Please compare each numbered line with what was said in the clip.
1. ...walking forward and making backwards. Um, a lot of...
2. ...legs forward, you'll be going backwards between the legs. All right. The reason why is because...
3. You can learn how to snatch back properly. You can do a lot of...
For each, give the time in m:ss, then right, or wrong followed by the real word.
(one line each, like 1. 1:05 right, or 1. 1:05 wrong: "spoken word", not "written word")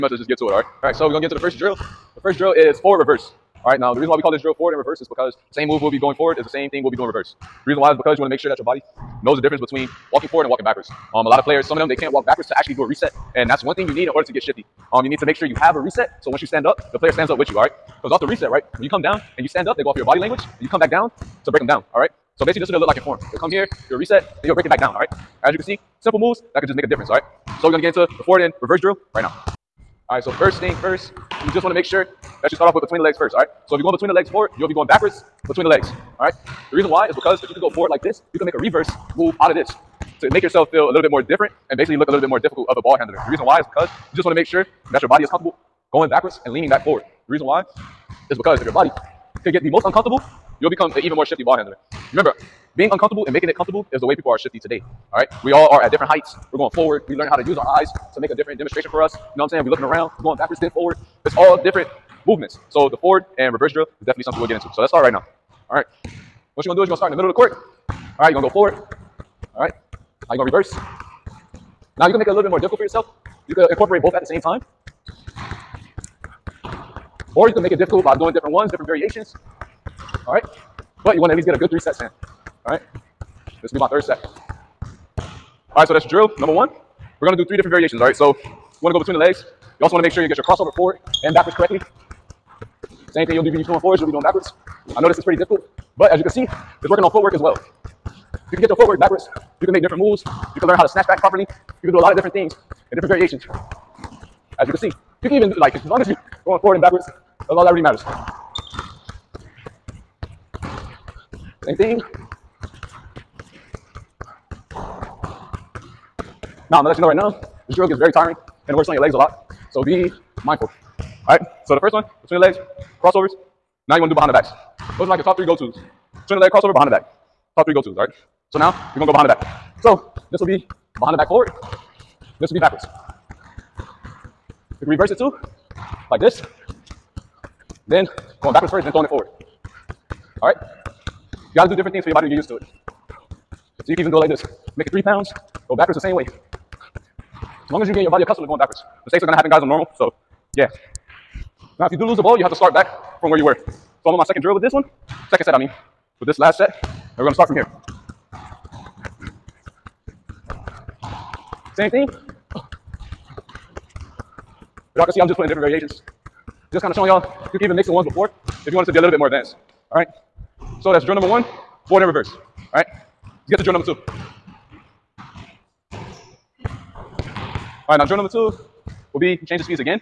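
1. 0:10 wrong: "walking", not "making"
2. 0:34 right
3. 1:40 right.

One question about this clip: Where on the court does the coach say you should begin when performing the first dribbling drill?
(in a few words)
Middle of the court.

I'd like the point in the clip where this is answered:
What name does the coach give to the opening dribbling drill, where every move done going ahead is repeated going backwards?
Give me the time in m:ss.
0:02.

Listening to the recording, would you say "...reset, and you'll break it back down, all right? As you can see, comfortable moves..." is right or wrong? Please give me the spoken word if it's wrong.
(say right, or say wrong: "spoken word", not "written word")
wrong: "simple", not "comfortable".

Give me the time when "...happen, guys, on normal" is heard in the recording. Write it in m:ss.
2:29.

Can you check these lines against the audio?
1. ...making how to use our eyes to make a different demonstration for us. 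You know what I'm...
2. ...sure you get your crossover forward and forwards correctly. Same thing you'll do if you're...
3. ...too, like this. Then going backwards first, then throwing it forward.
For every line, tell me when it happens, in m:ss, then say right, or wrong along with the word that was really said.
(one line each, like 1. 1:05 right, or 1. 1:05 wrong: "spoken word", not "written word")
1. 0:57 wrong: "learning", not "making"
2. 1:30 wrong: "backwards", not "forwards"
3. 2:15 right.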